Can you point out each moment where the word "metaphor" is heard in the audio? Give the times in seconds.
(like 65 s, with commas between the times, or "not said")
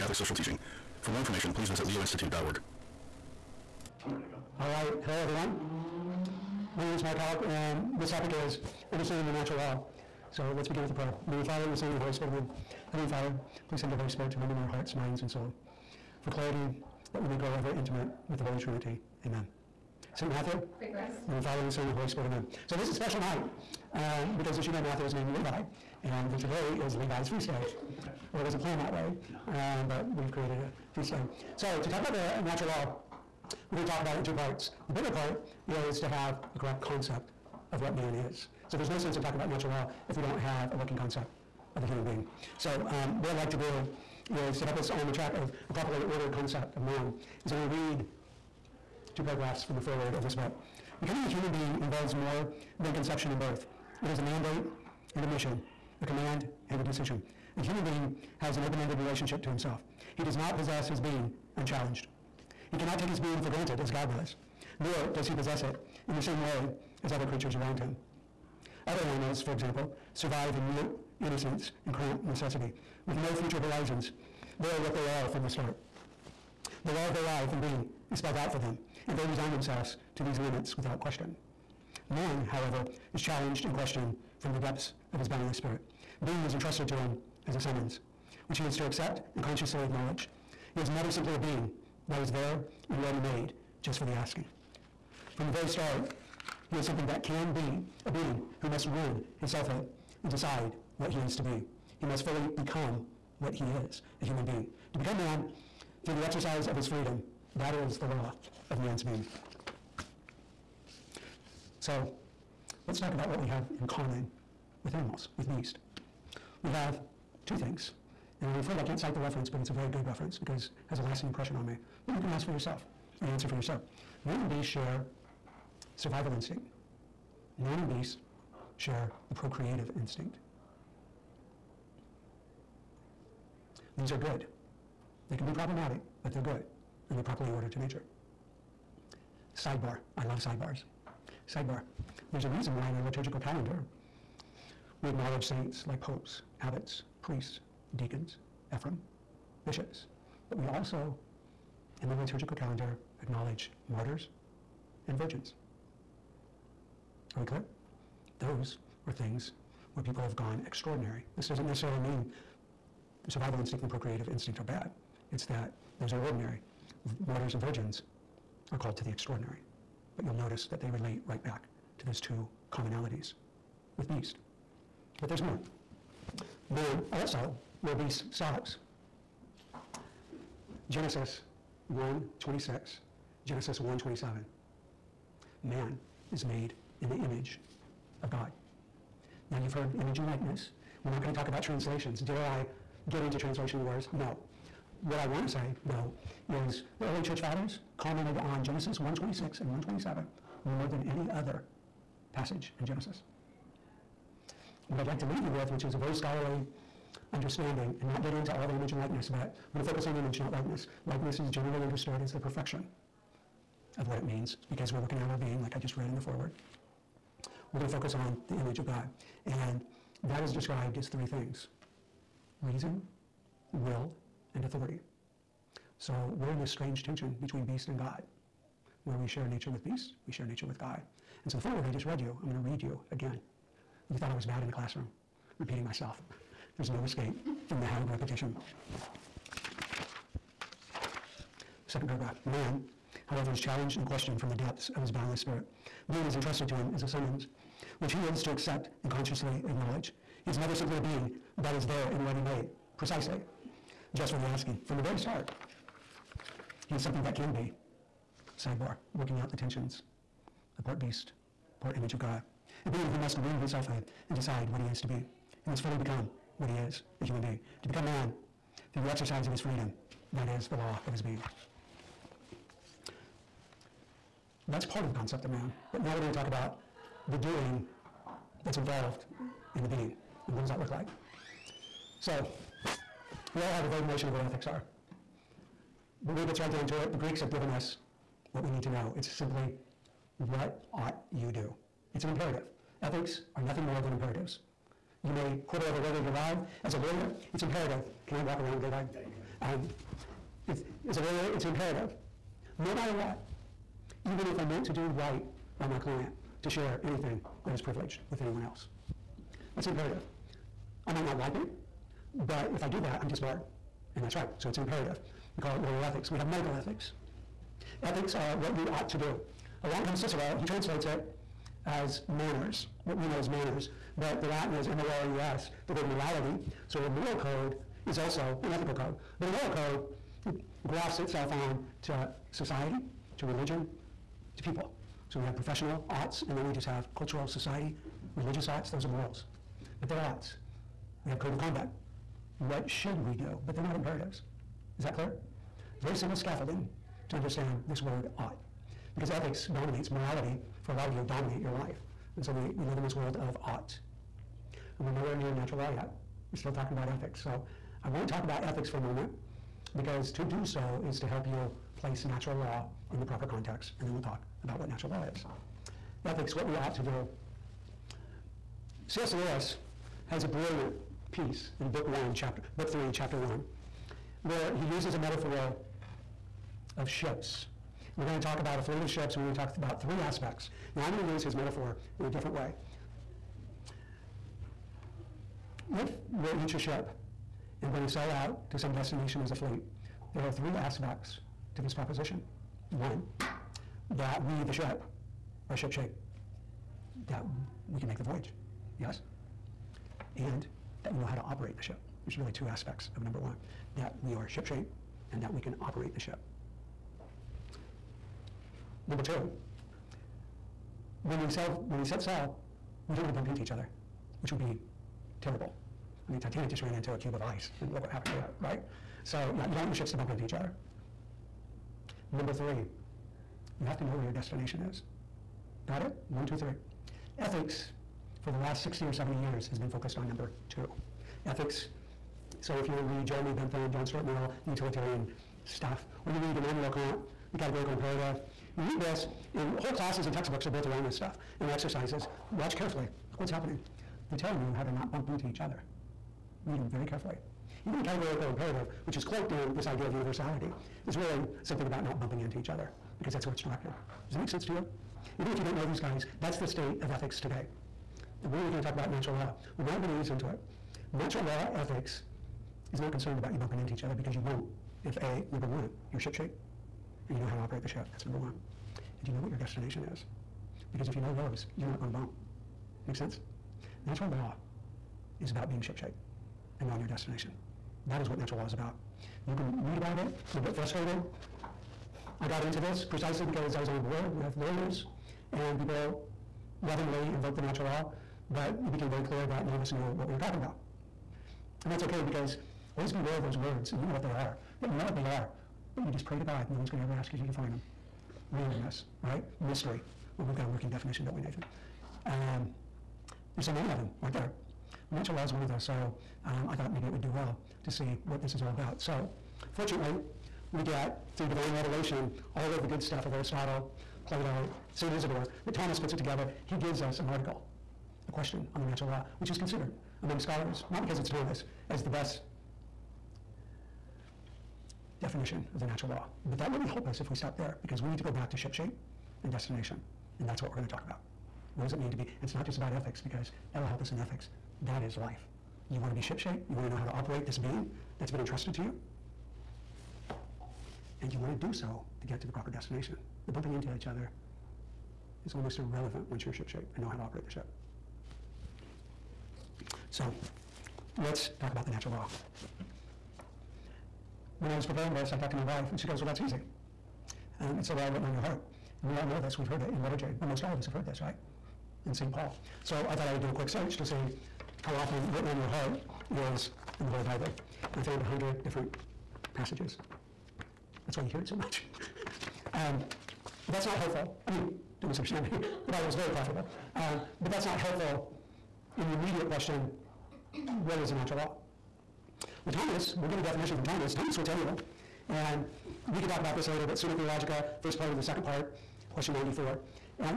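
375 s, 381 s.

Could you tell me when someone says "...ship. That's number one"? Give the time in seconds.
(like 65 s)
467 s.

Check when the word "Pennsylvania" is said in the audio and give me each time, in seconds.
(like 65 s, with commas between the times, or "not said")
not said.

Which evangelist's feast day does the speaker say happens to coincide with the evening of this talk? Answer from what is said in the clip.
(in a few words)
St. Matthew.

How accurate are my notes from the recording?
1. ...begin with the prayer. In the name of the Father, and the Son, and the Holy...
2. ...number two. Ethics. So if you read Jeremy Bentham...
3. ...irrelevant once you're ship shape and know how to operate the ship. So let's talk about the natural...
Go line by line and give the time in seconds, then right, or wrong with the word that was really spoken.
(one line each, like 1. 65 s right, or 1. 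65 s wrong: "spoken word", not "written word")
1. 10 s right
2. 430 s right
3. 545 s right.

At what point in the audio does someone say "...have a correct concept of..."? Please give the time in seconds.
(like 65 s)
36 s.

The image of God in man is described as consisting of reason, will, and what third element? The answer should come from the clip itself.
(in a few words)
authority.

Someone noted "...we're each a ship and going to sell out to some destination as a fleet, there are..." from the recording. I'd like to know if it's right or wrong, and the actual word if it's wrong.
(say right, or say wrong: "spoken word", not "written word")
right.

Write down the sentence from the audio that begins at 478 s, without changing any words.
That is what natural law is about.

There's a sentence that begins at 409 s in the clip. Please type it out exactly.
Number two, when we sell, when we set sell, we don't want to bump into each other, which would be terrible.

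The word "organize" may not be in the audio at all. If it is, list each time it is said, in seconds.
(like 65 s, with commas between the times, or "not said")
not said.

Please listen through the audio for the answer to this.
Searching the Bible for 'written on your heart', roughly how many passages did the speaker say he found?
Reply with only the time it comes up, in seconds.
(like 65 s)
568 s.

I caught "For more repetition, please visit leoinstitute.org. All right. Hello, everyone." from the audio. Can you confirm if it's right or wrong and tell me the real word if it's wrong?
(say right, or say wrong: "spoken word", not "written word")
wrong: "information", not "repetition".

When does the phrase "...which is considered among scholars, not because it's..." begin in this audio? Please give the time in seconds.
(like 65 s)
519 s.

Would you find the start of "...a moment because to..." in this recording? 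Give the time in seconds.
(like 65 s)
358 s.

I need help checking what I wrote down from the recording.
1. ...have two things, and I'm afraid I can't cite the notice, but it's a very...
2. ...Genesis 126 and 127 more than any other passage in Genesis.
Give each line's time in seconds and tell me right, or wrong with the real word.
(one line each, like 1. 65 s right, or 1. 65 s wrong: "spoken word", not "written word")
1. 116 s wrong: "reference", not "notice"
2. 198 s right.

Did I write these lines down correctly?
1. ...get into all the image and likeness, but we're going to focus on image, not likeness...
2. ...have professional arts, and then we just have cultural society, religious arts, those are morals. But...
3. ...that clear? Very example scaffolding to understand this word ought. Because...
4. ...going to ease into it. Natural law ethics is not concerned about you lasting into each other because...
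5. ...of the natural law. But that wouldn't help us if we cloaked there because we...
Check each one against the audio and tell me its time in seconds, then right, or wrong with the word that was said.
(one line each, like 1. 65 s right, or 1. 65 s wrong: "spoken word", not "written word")
1. 208 s right
2. 335 s right
3. 345 s wrong: "simple", not "example"
4. 460 s wrong: "bumping", not "lasting"
5. 525 s wrong: "stopped", not "cloaked".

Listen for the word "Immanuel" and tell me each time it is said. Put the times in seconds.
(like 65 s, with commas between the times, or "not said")
436 s.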